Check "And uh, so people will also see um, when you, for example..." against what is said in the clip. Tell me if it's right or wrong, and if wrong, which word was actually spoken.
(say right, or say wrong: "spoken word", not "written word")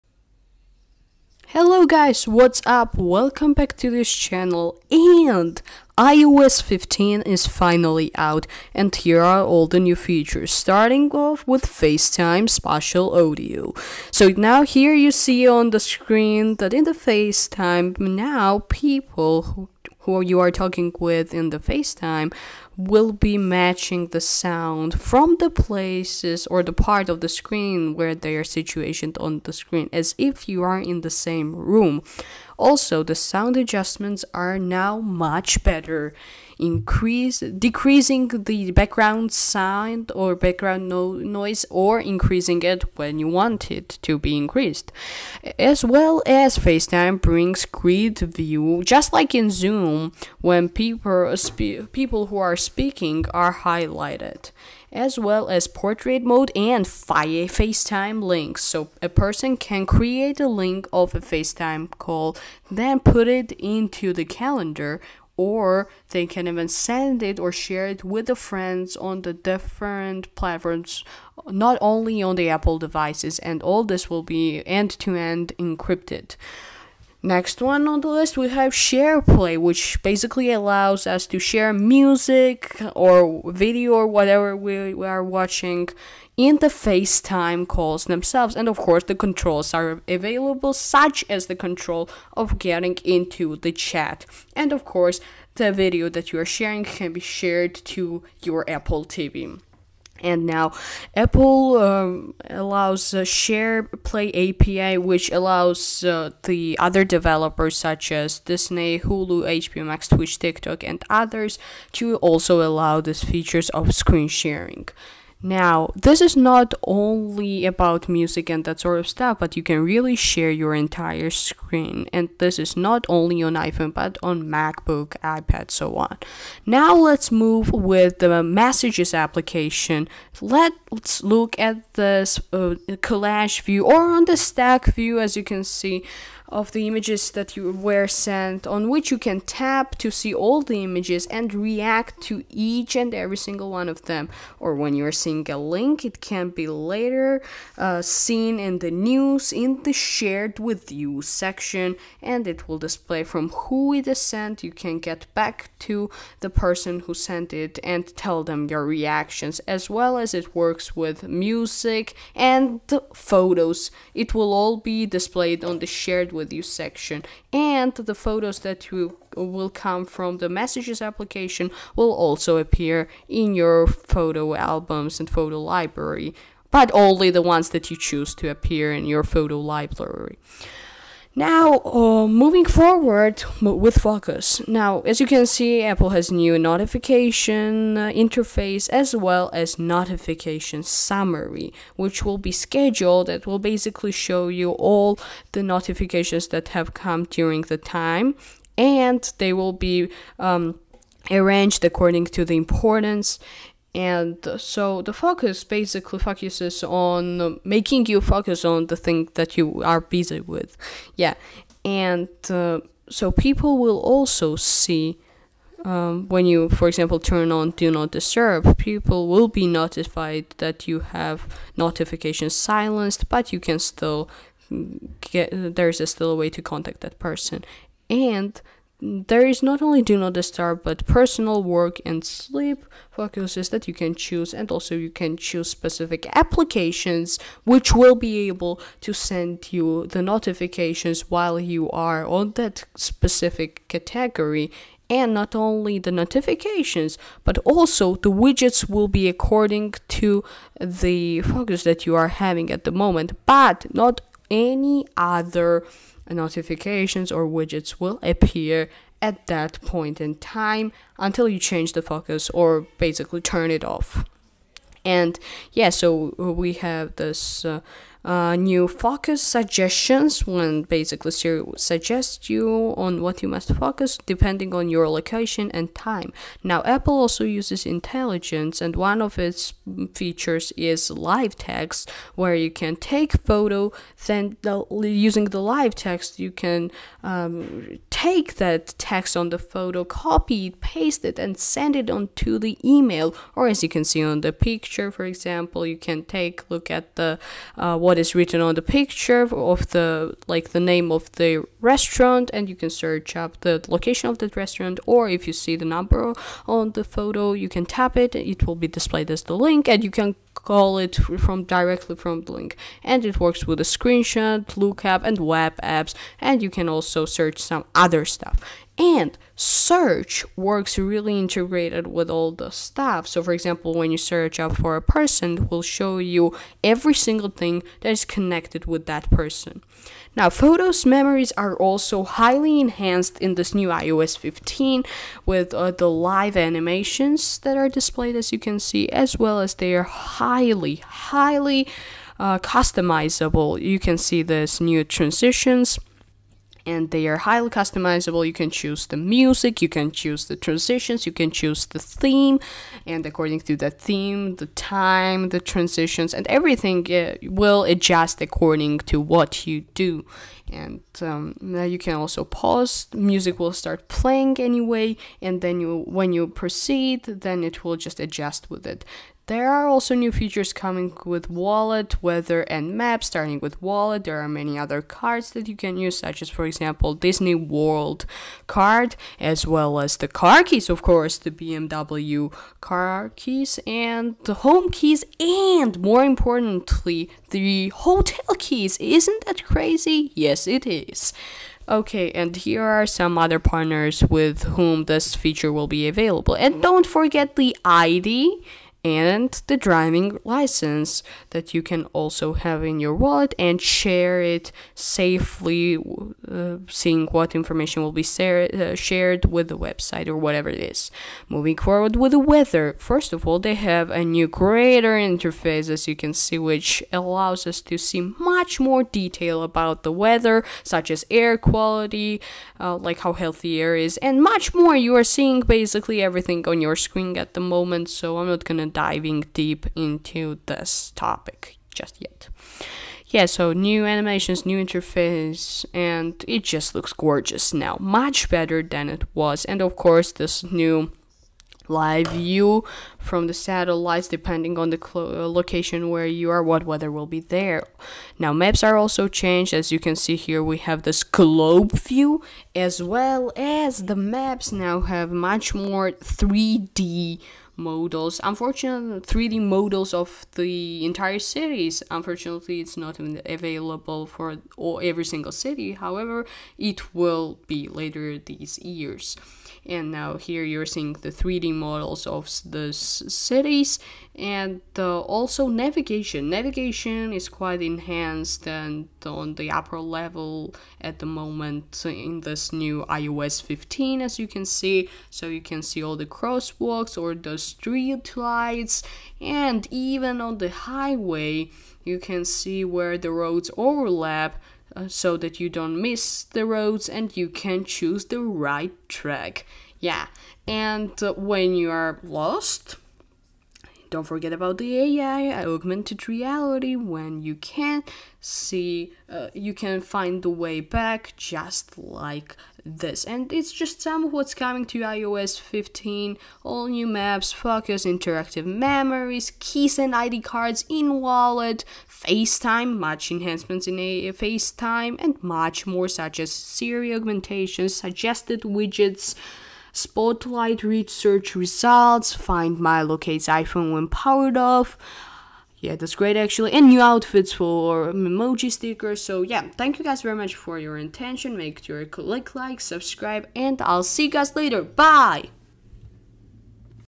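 right.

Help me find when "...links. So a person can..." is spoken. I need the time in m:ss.
0:58.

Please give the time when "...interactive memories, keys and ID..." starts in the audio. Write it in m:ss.
8:38.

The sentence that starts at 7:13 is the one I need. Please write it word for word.
Yeah, so new animations, new interface, and it just looks gorgeous now.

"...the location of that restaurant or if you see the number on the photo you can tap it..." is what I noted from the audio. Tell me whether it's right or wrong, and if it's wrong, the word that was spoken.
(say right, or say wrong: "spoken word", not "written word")
right.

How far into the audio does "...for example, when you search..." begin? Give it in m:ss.
5:23.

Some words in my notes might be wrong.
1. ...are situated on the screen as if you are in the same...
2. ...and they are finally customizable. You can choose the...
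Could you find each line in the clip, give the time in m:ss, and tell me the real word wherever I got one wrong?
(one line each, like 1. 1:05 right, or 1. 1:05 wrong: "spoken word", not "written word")
1. 0:28 right
2. 5:46 wrong: "highly", not "finally".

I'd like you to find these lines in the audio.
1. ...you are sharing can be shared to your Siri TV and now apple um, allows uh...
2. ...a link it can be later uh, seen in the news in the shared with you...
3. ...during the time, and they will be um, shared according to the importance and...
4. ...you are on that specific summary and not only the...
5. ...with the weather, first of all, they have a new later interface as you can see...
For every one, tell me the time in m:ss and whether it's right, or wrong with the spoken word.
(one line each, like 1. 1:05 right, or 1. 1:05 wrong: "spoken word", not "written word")
1. 1:36 wrong: "Apple", not "Siri"
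2. 2:25 right
3. 3:17 wrong: "arranged", not "shared"
4. 4:01 wrong: "category", not "summary"
5. 6:52 wrong: "greater", not "later".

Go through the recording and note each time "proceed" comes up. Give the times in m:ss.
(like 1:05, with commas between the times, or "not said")
6:06.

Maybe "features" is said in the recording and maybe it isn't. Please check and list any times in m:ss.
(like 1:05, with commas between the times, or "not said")
0:09, 1:53, 4:40, 6:10, 6:35.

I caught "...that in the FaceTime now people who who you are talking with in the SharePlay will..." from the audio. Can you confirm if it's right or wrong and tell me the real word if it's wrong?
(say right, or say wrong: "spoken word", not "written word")
wrong: "FaceTime", not "SharePlay".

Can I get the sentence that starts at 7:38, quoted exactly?
Unfortunately, 3D models of the entire cities.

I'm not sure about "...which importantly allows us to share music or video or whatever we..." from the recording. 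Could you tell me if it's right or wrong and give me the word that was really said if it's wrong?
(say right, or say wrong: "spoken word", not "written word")
wrong: "basically", not "importantly".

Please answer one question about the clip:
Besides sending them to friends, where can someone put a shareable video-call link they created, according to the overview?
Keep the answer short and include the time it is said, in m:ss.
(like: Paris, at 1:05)
the calendar, at 1:04.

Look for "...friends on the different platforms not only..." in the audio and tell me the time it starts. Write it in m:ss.
1:08.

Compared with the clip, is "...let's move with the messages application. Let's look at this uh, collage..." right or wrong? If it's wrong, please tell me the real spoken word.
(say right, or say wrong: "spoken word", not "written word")
right.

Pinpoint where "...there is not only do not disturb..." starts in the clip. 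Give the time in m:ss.
3:49.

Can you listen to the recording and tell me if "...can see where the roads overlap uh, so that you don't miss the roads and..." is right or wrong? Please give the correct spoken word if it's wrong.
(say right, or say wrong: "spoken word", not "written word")
right.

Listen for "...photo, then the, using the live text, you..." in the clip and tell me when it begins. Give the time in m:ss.
4:43.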